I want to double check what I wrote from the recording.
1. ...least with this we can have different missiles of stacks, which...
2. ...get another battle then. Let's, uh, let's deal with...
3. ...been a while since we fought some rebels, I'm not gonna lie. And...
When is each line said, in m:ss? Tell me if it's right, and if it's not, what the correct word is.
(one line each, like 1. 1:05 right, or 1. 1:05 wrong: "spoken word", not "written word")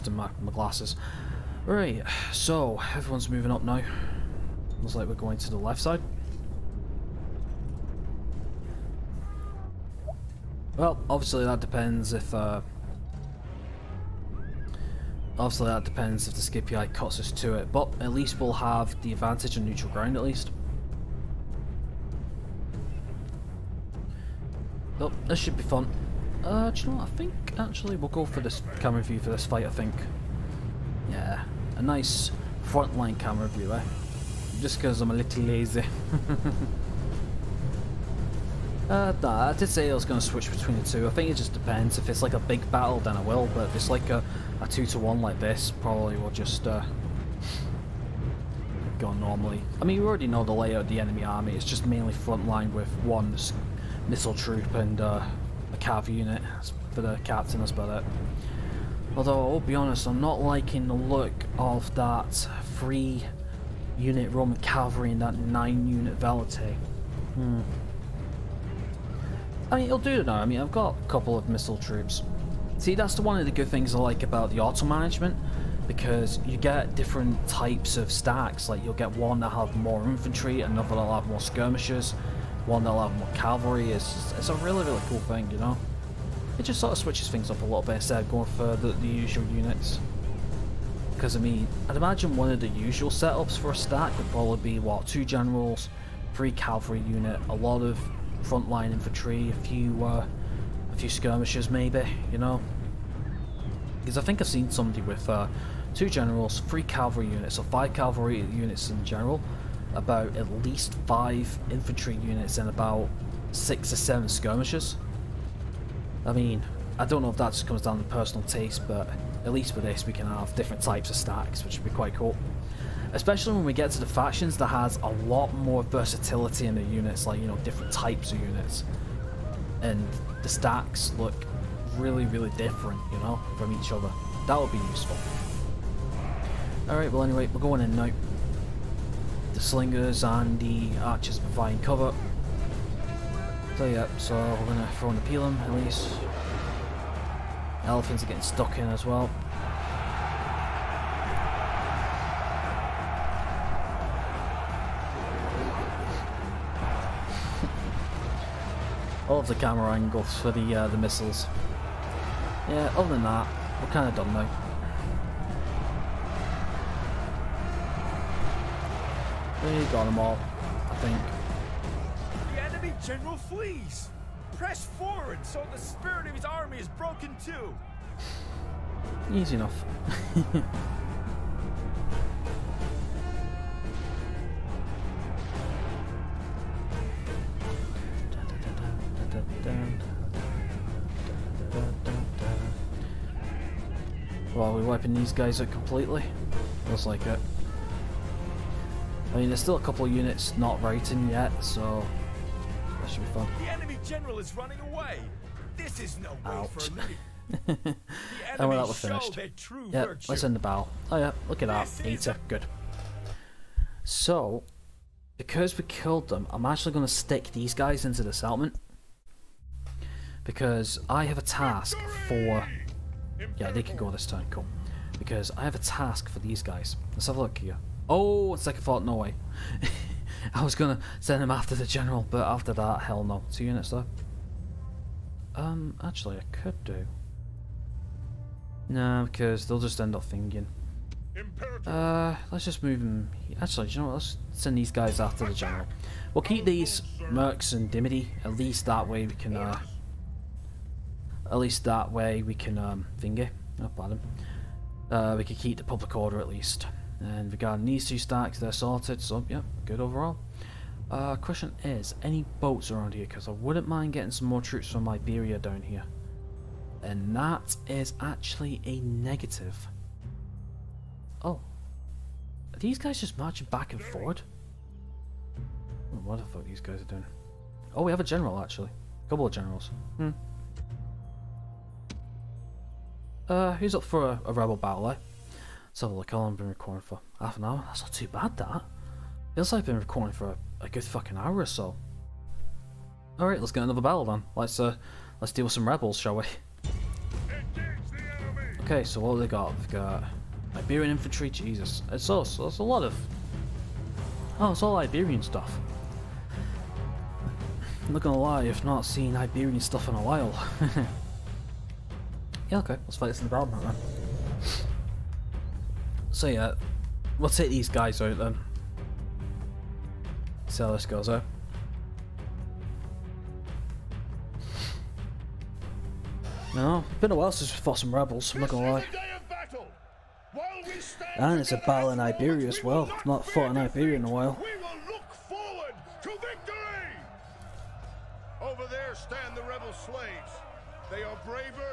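1. 1:59 wrong: "types", not "missiles"
2. 4:53 right
3. 5:27 right.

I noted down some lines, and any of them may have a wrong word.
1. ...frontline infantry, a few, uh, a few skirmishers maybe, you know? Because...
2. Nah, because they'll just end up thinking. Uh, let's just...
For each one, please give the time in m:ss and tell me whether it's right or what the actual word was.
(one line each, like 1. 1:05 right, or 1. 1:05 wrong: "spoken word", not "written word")
1. 1:38 right
2. 3:58 right.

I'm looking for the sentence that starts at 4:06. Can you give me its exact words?
We'll keep these Mercs and Dimity.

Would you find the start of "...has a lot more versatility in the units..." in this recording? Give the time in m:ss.
2:04.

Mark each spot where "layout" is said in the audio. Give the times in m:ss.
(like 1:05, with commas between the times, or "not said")
0:50.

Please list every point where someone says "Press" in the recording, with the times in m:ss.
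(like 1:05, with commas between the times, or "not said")
2:54.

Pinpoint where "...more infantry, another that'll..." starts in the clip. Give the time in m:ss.
1:19.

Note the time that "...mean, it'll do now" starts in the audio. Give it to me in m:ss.
1:09.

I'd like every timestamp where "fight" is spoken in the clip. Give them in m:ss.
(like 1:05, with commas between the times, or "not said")
0:29, 5:13.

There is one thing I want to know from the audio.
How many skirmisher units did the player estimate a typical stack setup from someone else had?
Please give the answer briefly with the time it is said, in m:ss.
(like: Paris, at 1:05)
6 or 7, at 1:53.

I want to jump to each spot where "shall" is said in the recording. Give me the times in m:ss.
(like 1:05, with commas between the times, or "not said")
4:56.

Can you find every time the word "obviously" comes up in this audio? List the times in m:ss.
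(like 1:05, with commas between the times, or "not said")
0:11, 0:15.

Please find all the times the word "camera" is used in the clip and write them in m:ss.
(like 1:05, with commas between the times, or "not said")
0:28, 0:33, 2:39.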